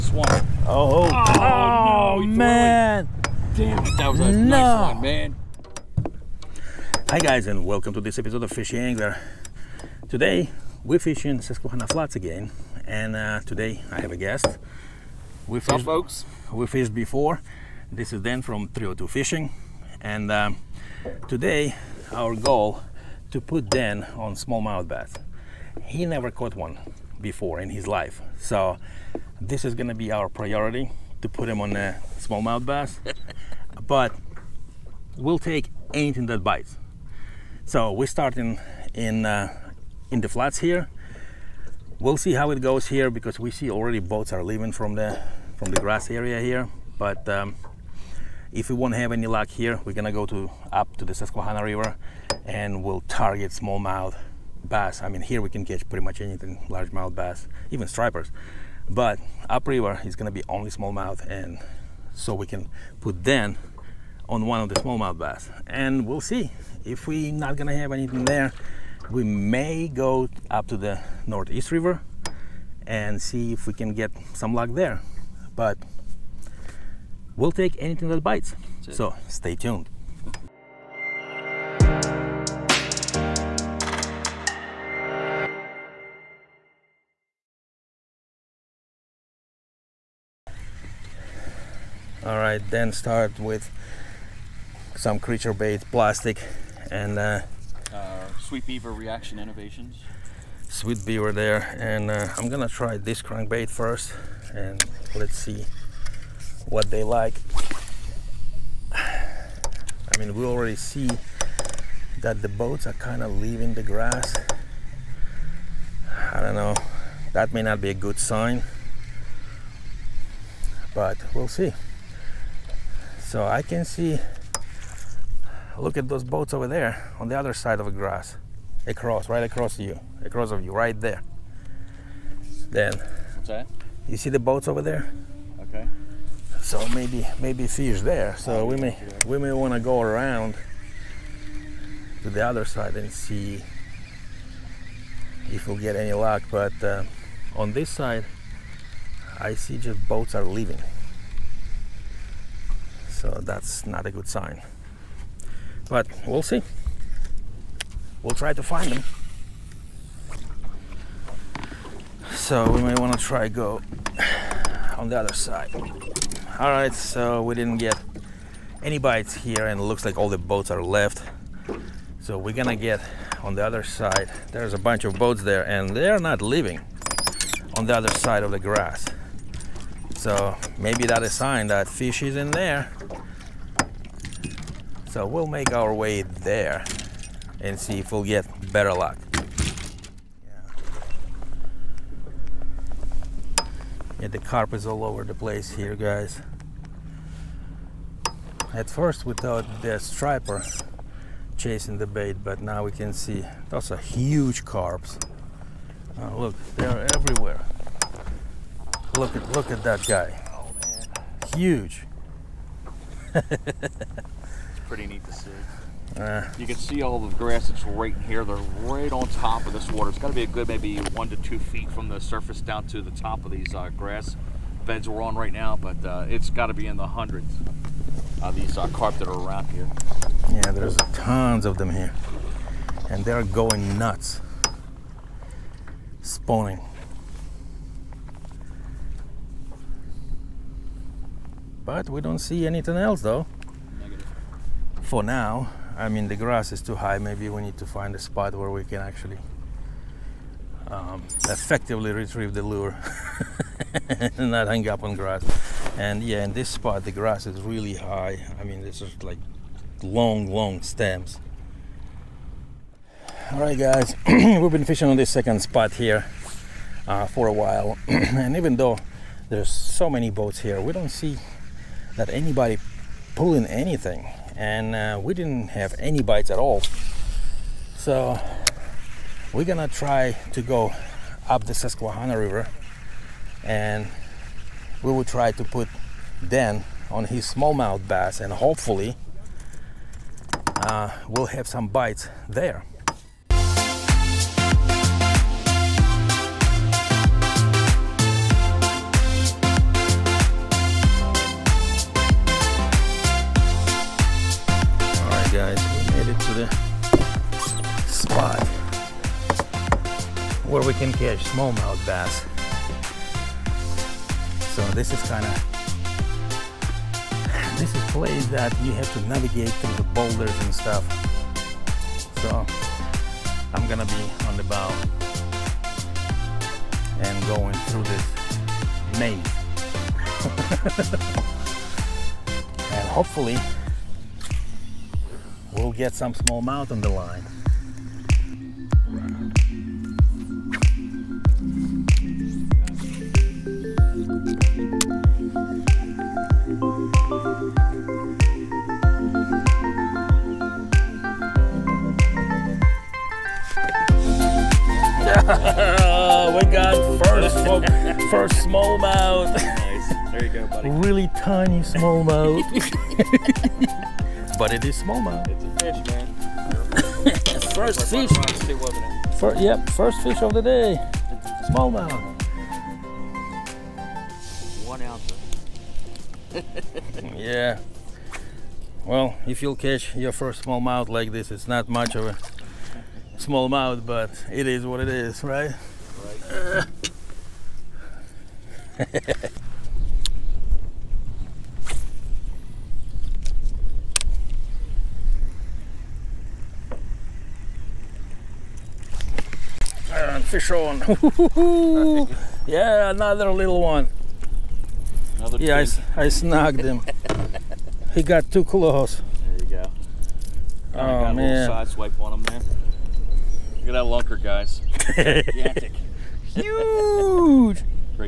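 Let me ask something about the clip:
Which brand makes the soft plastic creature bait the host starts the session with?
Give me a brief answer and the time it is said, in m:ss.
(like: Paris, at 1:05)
Reaction Innovations, at 1:38.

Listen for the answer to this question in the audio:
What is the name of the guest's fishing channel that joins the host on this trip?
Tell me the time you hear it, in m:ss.
0:18.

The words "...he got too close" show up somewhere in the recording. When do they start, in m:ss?
6:48.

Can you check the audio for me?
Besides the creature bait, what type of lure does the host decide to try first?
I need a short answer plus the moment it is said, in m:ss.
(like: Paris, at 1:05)
Crankbait, at 1:43.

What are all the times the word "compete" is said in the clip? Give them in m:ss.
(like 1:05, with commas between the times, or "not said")
not said.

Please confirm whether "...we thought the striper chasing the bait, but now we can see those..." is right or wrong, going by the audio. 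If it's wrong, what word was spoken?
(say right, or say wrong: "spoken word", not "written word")
right.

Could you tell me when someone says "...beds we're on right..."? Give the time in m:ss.
3:44.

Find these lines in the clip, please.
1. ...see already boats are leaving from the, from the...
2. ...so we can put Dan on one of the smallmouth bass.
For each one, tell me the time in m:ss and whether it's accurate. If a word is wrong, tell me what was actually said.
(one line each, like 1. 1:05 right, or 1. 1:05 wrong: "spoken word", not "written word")
1. 0:43 right
2. 1:02 right.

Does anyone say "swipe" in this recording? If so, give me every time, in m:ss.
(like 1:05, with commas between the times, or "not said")
6:51.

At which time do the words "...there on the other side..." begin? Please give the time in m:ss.
2:06.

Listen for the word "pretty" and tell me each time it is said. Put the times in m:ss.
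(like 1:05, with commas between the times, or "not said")
0:55, 3:34.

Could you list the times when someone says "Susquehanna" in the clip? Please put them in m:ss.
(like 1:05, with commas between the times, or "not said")
0:11, 0:51, 4:41.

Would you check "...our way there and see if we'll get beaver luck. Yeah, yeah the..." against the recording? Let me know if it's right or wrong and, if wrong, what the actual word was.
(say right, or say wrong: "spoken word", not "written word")
wrong: "better", not "beaver".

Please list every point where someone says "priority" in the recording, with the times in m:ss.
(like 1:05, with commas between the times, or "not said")
0:30.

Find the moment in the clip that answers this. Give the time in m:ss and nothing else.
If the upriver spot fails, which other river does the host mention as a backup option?
1:11.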